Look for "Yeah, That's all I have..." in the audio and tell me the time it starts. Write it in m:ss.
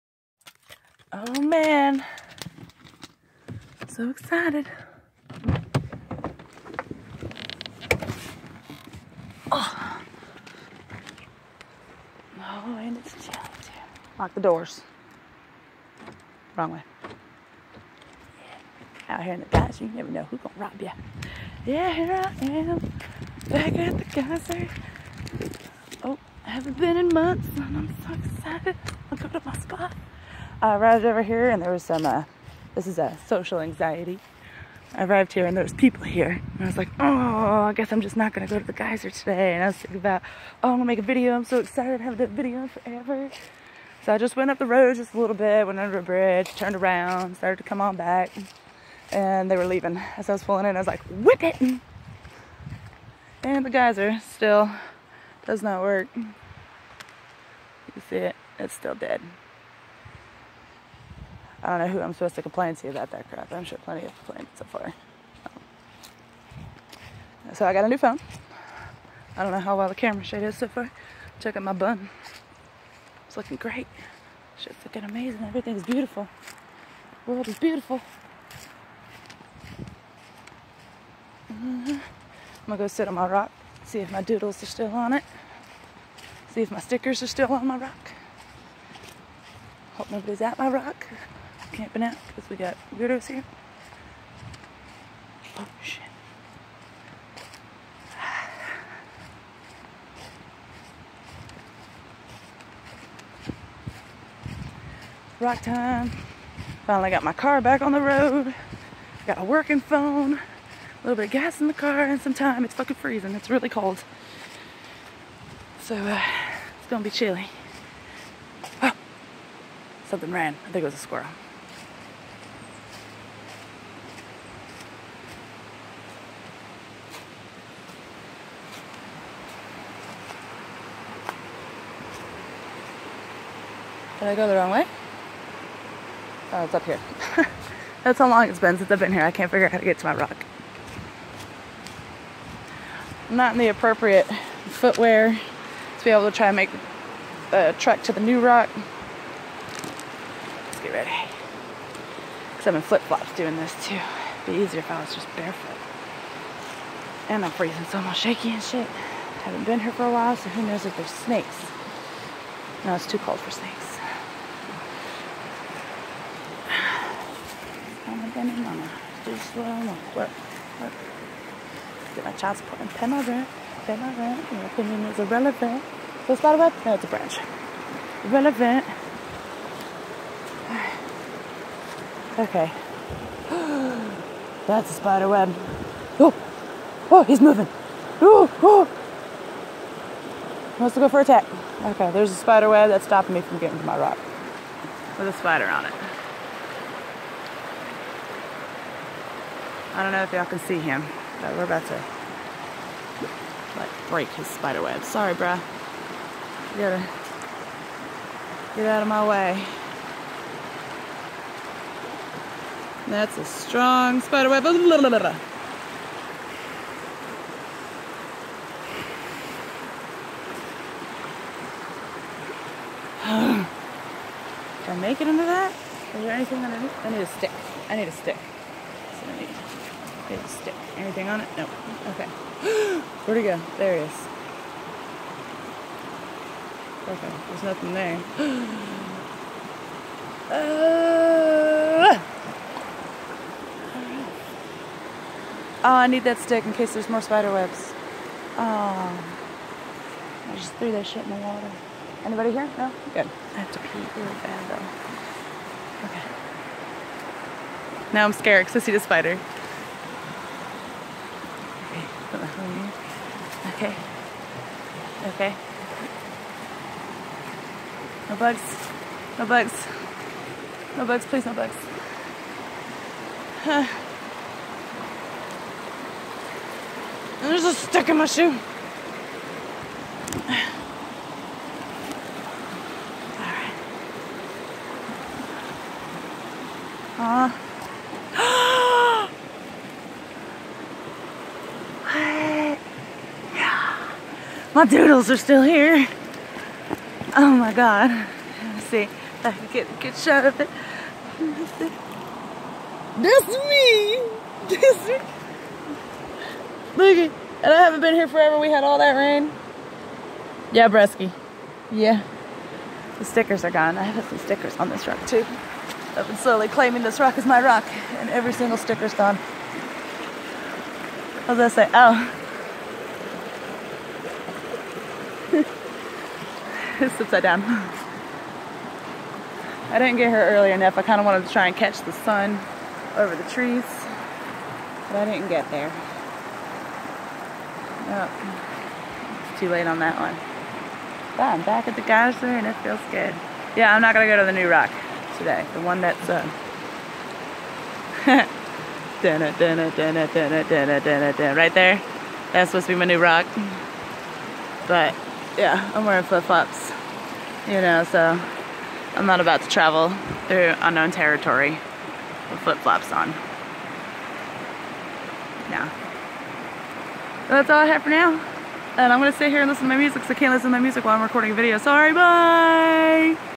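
6:05.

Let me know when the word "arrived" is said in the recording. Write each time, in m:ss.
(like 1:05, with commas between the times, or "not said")
0:30, 0:35.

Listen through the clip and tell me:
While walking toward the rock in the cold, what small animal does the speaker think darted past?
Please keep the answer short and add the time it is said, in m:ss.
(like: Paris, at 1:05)
squirrel, at 2:00.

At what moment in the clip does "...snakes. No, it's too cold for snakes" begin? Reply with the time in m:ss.
2:41.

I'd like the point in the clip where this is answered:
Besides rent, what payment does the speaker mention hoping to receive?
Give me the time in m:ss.
2:52.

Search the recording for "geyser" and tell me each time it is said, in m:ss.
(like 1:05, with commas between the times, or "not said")
0:38, 0:53, 5:42.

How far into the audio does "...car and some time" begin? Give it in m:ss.
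1:51.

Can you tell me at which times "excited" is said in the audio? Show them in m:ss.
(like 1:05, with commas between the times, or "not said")
0:04, 0:28, 0:41.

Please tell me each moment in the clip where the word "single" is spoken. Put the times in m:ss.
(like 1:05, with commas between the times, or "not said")
5:18.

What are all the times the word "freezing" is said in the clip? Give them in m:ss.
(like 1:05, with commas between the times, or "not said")
1:52, 2:37.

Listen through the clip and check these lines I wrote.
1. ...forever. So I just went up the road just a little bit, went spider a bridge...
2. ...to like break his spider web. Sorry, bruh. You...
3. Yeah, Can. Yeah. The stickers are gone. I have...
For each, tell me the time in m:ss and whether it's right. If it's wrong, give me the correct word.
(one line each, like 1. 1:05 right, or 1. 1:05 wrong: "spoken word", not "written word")
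1. 0:42 wrong: "under", not "spider"
2. 3:21 right
3. 5:10 wrong: "Bresky", not "Can".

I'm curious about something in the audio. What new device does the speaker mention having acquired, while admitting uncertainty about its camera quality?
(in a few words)
new phone.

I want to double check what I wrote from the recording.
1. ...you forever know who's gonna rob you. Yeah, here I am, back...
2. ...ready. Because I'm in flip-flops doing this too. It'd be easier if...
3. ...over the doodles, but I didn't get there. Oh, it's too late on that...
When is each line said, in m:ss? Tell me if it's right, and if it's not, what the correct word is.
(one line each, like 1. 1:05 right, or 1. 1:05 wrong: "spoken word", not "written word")
1. 0:19 wrong: "never", not "forever"
2. 2:30 right
3. 5:33 wrong: "trees", not "doodles".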